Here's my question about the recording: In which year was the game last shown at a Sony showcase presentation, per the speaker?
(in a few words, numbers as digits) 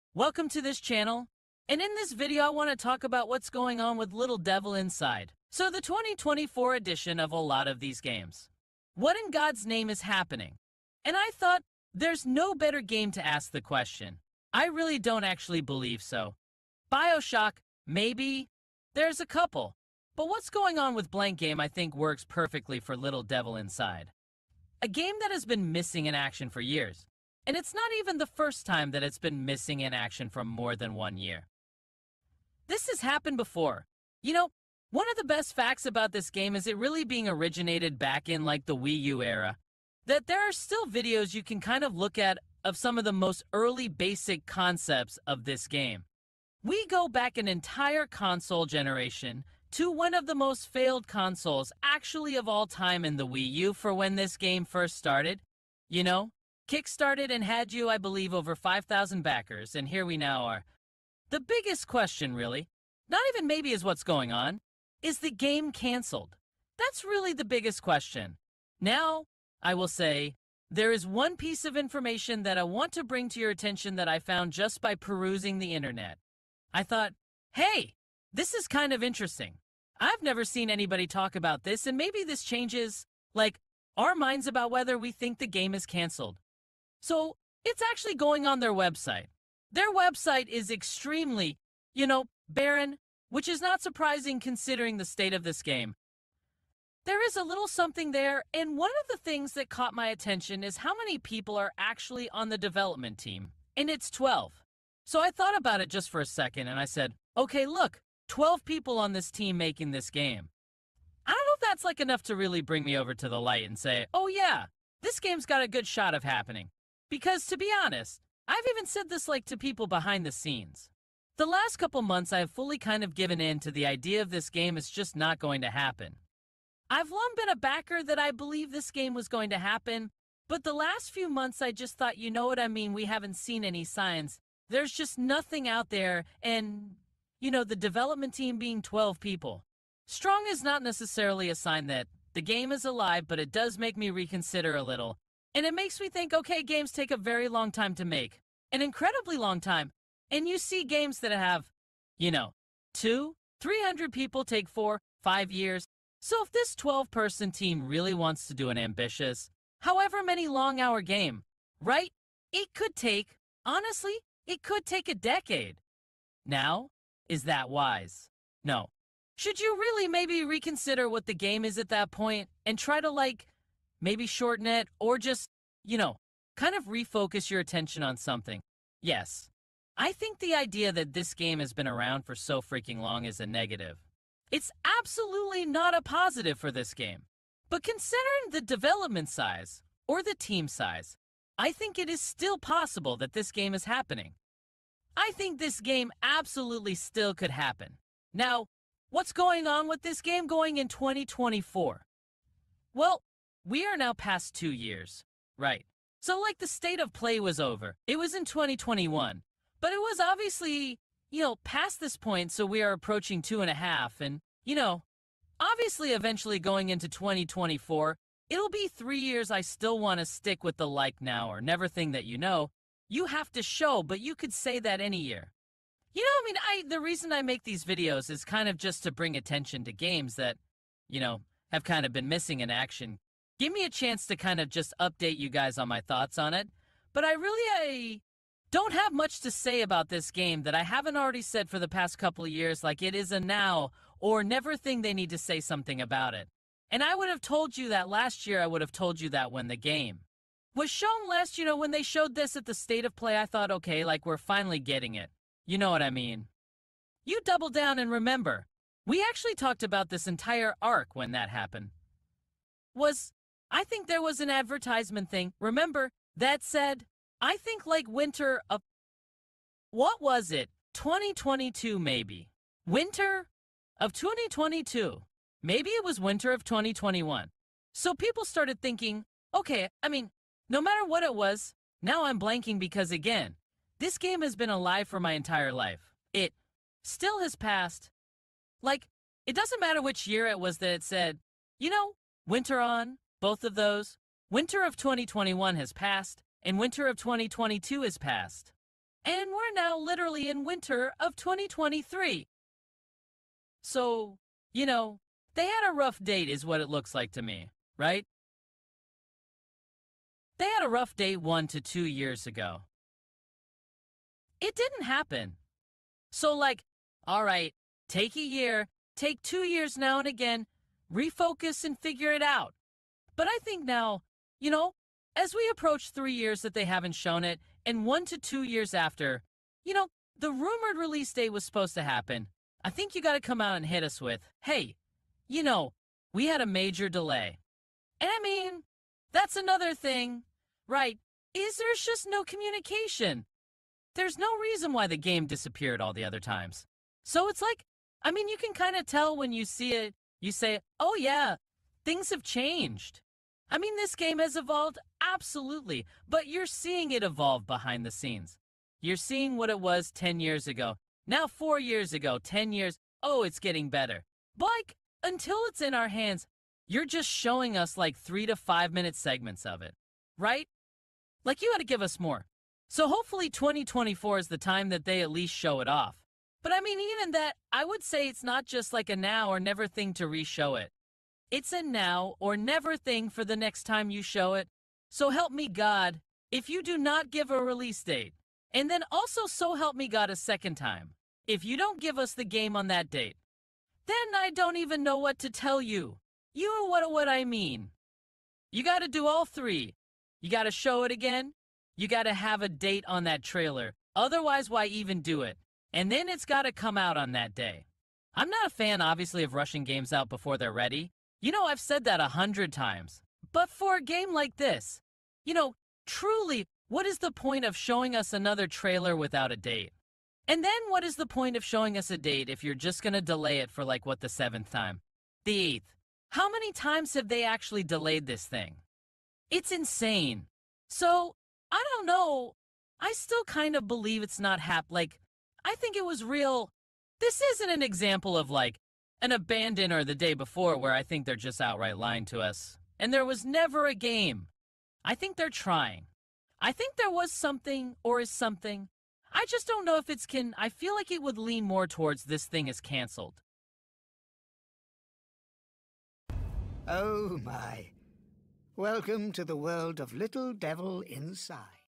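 2021.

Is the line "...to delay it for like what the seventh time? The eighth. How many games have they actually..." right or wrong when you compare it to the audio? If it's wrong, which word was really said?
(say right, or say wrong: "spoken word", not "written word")
wrong: "times", not "games".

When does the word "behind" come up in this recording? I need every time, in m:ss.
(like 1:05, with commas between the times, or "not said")
1:59, 5:57.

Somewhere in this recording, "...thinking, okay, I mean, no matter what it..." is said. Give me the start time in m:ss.
4:38.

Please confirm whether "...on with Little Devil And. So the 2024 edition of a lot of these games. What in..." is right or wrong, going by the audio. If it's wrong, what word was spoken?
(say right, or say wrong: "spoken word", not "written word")
wrong: "Inside", not "And".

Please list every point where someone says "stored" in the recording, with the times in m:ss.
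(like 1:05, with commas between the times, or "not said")
not said.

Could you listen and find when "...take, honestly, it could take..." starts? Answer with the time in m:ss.
2:42.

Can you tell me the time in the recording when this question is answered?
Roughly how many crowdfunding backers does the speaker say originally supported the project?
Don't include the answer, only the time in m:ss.
0:58.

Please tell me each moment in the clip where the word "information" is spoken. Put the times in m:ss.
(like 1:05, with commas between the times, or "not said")
1:11.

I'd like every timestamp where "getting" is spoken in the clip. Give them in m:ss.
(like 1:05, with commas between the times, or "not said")
4:14, 6:03.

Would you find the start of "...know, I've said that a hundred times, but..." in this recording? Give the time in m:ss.
6:51.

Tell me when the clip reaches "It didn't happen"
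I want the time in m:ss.
5:14.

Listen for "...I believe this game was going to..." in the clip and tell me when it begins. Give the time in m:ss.
2:08.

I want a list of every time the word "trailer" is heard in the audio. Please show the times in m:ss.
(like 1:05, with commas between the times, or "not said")
6:43, 6:58.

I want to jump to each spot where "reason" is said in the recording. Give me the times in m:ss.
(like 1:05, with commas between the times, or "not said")
3:47, 5:44.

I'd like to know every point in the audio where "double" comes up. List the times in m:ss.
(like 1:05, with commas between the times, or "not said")
4:17.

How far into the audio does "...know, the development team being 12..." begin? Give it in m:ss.
2:17.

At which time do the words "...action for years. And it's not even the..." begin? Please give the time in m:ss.
0:26.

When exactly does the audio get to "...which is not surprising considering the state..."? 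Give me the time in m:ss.
1:33.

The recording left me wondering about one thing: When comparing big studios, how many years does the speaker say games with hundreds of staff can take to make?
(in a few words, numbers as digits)
four, five years.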